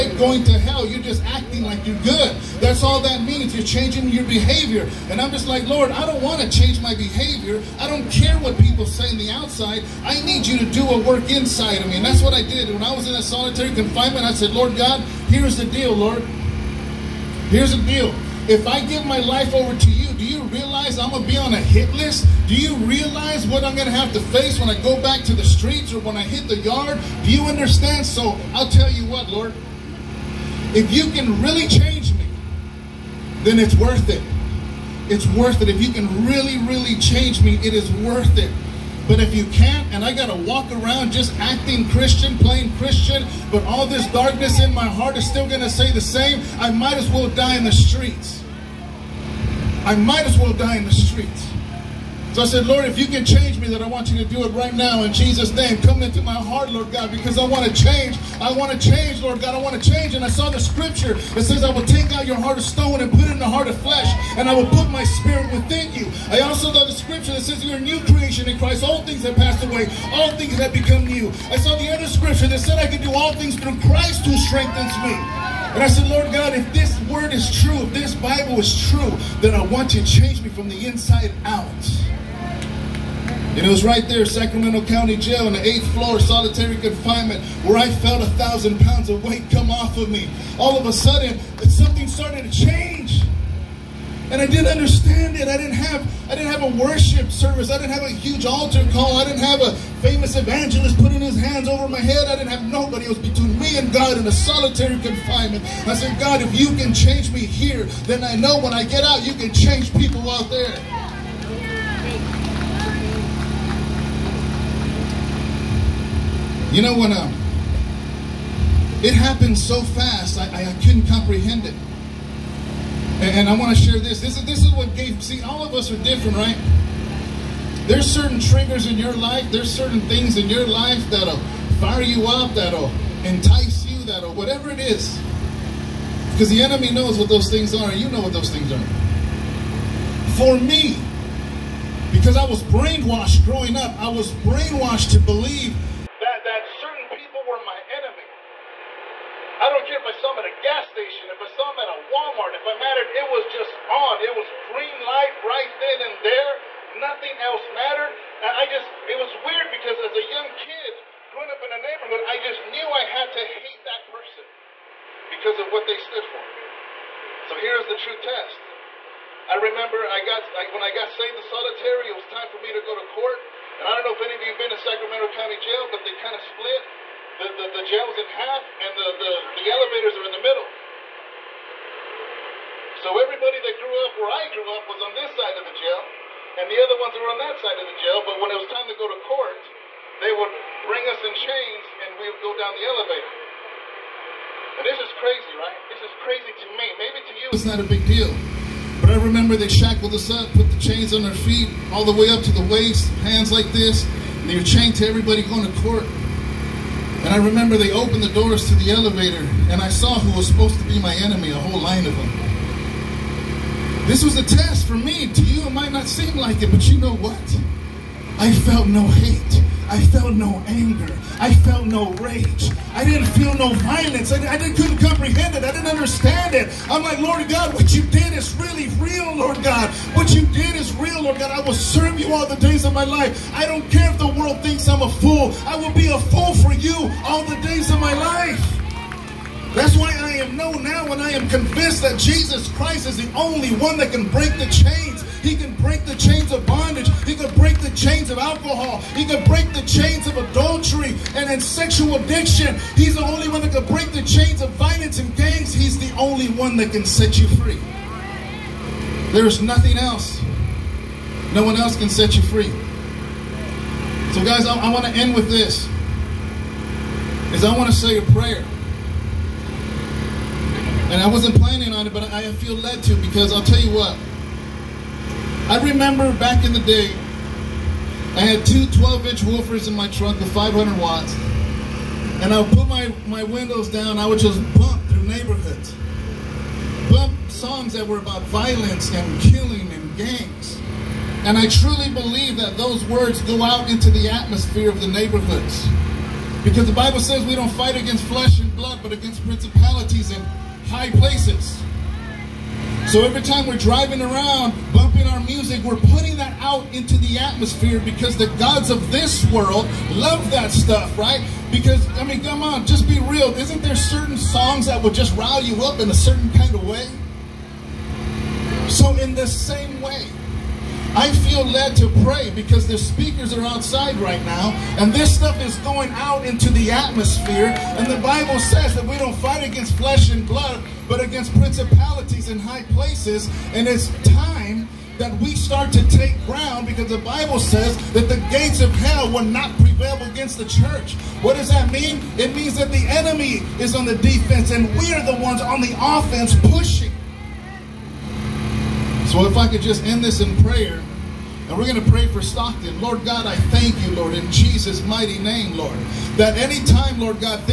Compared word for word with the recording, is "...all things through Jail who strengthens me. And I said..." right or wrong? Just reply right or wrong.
wrong.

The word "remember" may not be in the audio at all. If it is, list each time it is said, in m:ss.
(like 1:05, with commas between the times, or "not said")
2:49, 3:19, 3:27, 4:35.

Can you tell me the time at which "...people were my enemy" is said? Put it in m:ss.
2:27.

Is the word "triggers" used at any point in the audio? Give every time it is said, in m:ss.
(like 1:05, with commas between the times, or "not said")
2:08.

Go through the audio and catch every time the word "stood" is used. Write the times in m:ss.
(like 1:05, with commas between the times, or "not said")
2:45.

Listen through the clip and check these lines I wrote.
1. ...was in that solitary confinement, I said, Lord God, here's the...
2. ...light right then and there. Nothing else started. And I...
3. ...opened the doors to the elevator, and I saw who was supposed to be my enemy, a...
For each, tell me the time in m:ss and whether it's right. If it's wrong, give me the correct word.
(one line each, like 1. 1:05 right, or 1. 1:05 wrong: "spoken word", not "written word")
1. 0:12 right
2. 2:35 wrong: "mattered", not "started"
3. 3:27 right.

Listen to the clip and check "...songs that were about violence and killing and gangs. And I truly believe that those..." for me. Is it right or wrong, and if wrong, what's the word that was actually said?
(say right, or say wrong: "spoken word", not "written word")
right.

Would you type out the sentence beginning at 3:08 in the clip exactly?
But when it was time to go to court, they would bring us in chains and we would go down the elevator.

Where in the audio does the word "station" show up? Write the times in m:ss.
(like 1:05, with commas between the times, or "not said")
2:30.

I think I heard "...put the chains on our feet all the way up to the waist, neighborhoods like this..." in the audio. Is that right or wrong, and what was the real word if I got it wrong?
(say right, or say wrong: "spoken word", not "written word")
wrong: "hands", not "neighborhoods".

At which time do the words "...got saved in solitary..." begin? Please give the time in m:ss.
2:50.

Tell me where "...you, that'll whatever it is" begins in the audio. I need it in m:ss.
2:13.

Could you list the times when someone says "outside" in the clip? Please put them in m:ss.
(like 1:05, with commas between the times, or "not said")
0:09, 5:23.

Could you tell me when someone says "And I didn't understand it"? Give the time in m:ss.
1:34.